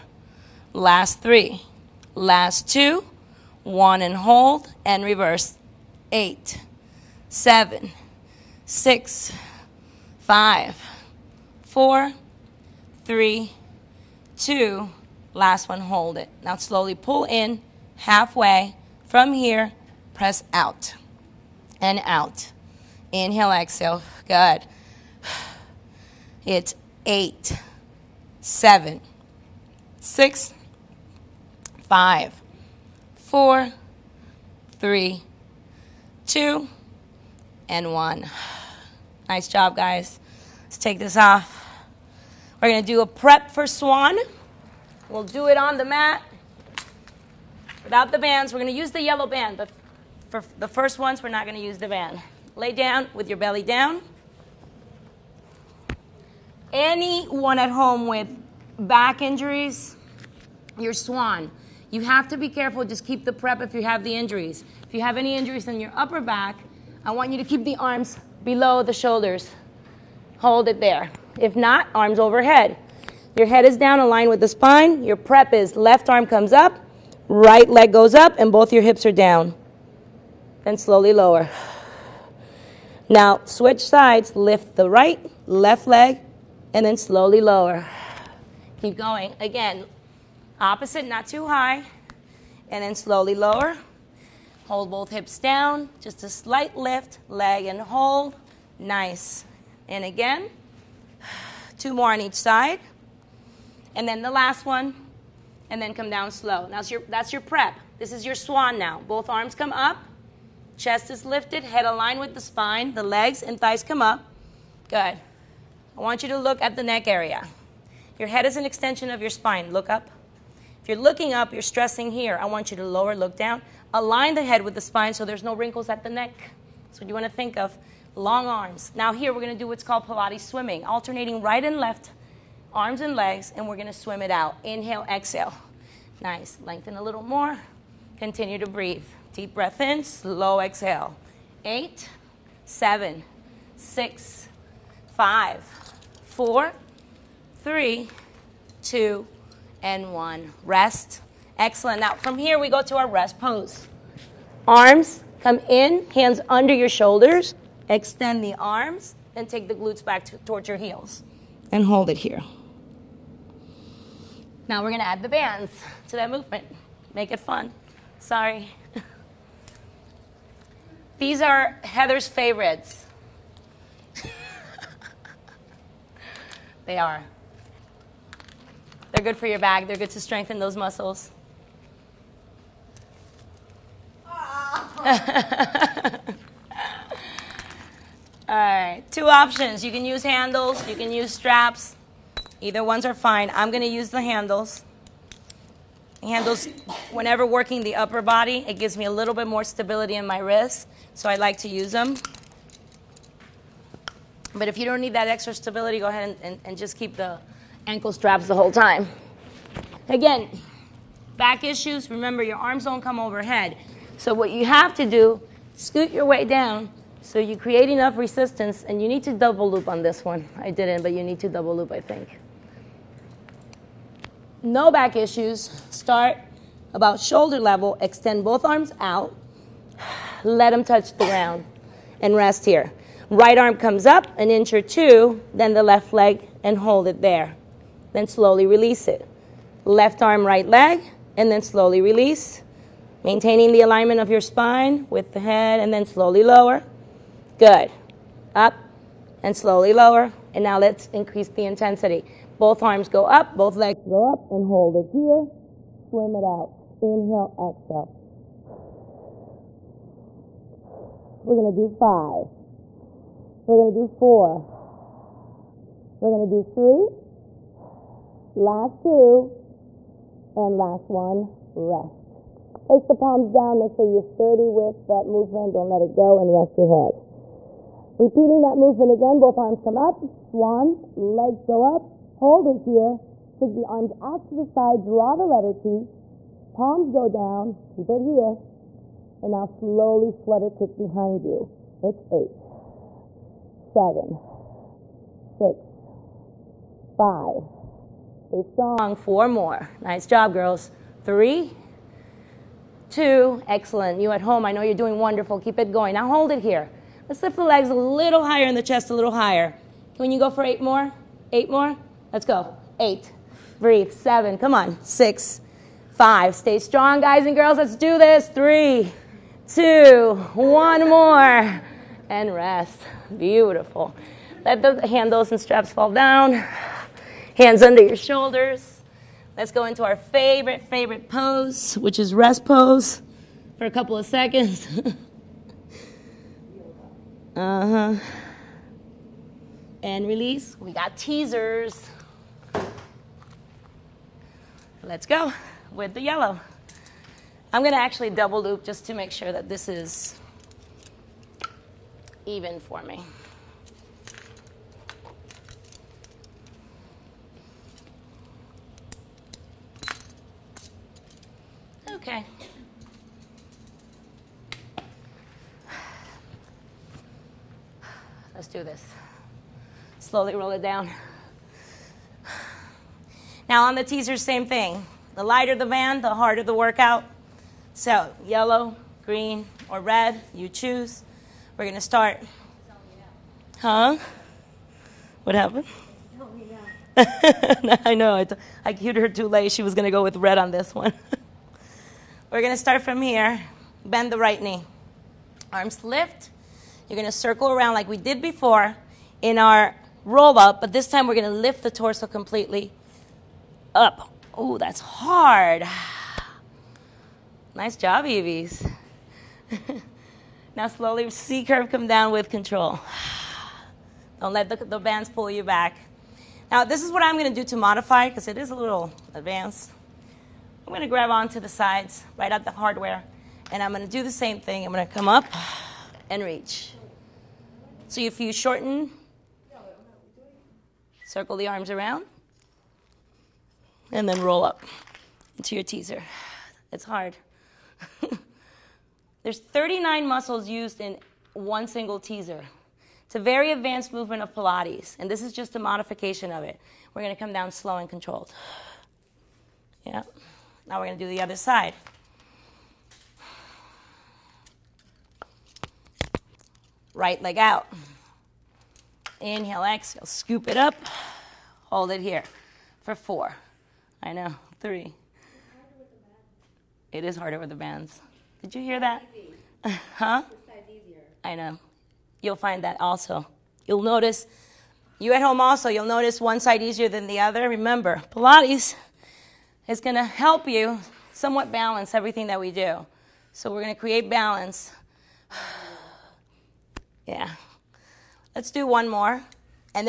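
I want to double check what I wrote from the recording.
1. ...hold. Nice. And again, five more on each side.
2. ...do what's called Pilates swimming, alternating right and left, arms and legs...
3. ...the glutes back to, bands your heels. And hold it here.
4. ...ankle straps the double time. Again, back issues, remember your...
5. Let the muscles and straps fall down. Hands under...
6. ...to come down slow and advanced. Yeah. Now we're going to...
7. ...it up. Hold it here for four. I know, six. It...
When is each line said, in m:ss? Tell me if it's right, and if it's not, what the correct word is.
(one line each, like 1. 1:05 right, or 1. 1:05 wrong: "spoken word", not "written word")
1. 1:37 wrong: "two", not "five"
2. 2:09 right
3. 2:39 wrong: "towards", not "bands"
4. 3:27 wrong: "whole", not "double"
5. 5:24 wrong: "handles", not "muscles"
6. 7:27 wrong: "controlled", not "advanced"
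7. 7:40 wrong: "three", not "six".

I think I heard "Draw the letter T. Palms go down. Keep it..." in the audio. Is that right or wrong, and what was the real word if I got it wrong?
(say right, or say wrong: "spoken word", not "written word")
right.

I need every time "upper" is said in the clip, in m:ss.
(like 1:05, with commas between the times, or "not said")
1:05, 3:17.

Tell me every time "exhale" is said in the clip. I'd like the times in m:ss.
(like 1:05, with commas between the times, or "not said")
0:23, 2:15, 2:20, 4:17, 7:39.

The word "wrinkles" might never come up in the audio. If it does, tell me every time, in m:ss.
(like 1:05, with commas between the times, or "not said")
2:05.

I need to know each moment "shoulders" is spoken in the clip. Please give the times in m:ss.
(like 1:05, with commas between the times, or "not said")
1:08, 2:36, 3:47, 5:28.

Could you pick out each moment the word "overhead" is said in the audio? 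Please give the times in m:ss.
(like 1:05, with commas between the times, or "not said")
1:12, 3:33.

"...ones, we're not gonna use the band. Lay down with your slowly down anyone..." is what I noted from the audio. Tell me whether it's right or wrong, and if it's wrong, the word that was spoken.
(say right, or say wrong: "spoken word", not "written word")
wrong: "belly", not "slowly".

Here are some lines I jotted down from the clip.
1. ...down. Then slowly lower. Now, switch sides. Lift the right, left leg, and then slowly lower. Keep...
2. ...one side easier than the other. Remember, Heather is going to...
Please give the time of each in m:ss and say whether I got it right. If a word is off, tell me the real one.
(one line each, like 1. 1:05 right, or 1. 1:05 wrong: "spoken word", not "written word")
1. 1:19 right
2. 7:56 wrong: "Pilates", not "Heather".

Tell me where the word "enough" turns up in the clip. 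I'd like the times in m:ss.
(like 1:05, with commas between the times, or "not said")
3:37.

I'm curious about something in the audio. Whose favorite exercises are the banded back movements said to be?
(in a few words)
Heather's.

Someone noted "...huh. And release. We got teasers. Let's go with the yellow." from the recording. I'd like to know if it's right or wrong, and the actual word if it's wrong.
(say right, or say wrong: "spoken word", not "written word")
right.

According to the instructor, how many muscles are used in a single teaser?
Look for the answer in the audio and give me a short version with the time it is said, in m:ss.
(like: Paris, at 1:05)
39, at 7:19.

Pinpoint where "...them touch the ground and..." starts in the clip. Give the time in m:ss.
3:50.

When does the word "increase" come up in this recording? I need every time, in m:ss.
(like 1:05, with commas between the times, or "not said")
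4:11.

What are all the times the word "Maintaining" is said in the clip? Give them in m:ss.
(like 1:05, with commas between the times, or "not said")
4:03.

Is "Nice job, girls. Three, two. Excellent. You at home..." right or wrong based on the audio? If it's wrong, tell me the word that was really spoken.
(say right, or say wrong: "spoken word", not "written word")
right.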